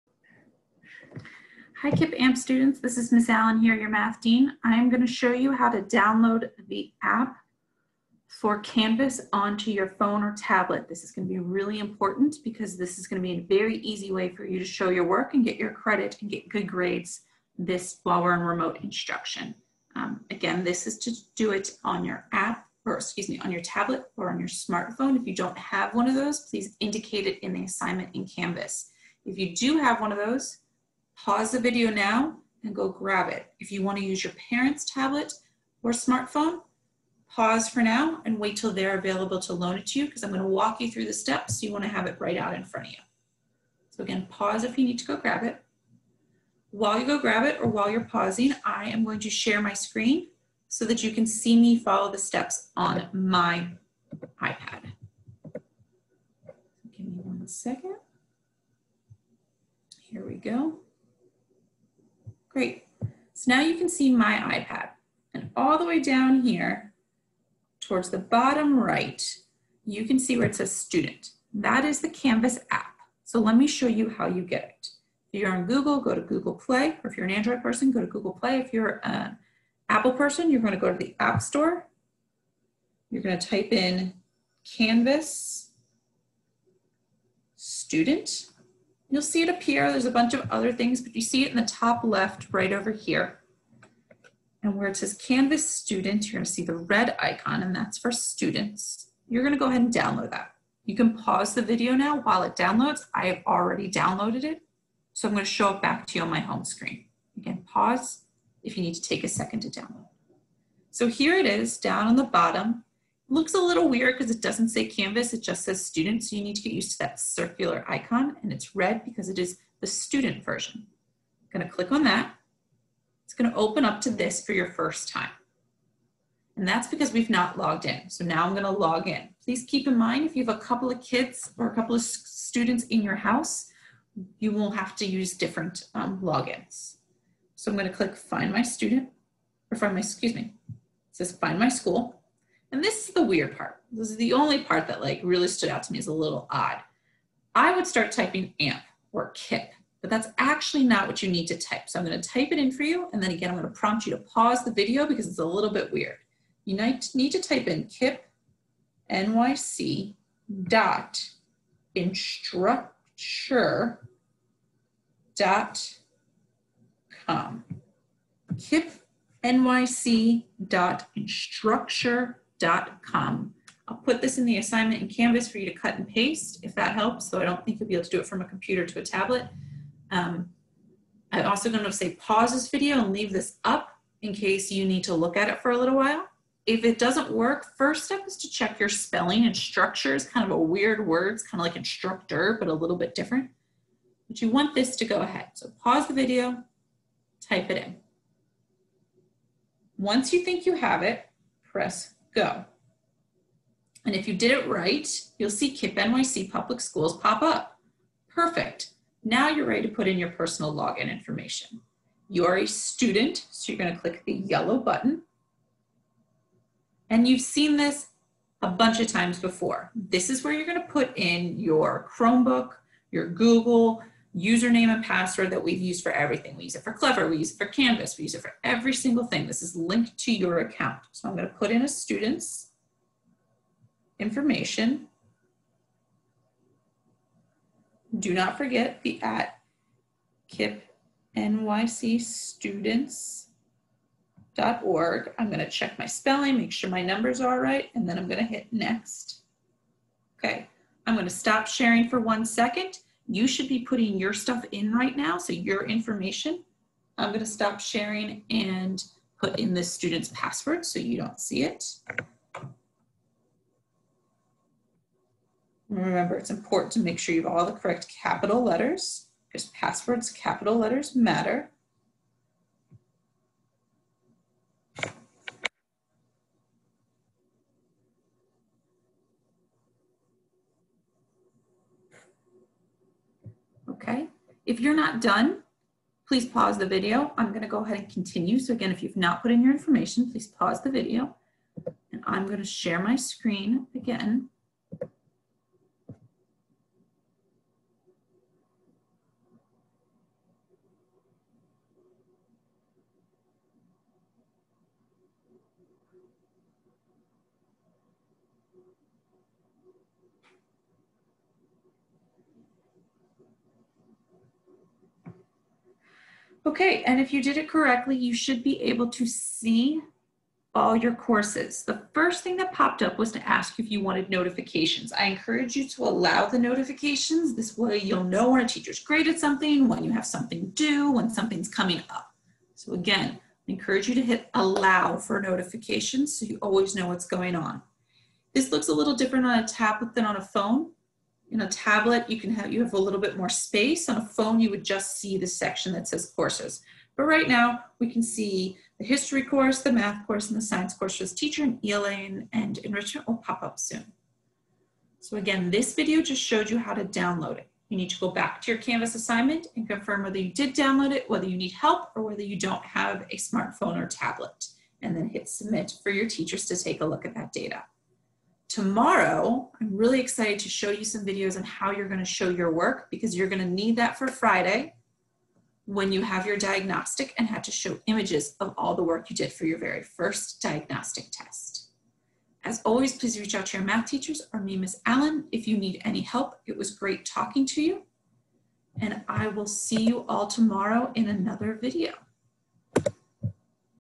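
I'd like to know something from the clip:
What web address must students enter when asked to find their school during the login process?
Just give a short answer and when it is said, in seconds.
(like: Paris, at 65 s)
KIPP NYC dot instructure dot com, at 157 s.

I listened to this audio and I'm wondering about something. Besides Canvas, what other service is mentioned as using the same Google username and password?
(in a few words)
Clever.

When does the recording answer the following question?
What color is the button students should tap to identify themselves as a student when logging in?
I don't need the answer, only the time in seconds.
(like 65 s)
214 s.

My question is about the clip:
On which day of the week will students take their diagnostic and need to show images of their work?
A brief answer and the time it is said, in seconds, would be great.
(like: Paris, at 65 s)
Friday, at 374 s.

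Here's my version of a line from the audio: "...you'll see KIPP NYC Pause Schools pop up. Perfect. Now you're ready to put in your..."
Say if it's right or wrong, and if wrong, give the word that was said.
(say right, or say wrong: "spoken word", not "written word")
wrong: "Public", not "Pause".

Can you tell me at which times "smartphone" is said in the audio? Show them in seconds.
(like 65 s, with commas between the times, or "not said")
24 s, 35 s, 363 s.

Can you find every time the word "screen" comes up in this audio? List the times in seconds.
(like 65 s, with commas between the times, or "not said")
49 s, 106 s, 293 s.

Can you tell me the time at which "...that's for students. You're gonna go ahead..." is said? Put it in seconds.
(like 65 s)
97 s.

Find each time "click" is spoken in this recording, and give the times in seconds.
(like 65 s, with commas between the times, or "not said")
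121 s, 137 s, 213 s.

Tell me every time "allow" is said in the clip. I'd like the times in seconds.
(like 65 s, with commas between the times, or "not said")
326 s, 334 s.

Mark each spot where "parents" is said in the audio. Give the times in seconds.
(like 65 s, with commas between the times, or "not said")
34 s.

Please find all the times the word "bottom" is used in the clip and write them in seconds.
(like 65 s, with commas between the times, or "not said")
68 s, 112 s.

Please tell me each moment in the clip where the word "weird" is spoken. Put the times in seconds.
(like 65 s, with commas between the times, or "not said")
113 s, 143 s, 155 s, 190 s.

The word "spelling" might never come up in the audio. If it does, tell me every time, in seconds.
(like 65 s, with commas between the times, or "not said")
188 s, 246 s.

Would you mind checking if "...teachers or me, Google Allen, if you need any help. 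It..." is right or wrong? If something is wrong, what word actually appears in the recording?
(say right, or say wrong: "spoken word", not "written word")
wrong: "Miss", not "Google".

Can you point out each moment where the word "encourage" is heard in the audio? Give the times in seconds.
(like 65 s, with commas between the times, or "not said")
325 s, 333 s.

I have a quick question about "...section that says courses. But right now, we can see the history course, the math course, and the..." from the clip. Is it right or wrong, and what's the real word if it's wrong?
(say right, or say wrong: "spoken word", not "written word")
right.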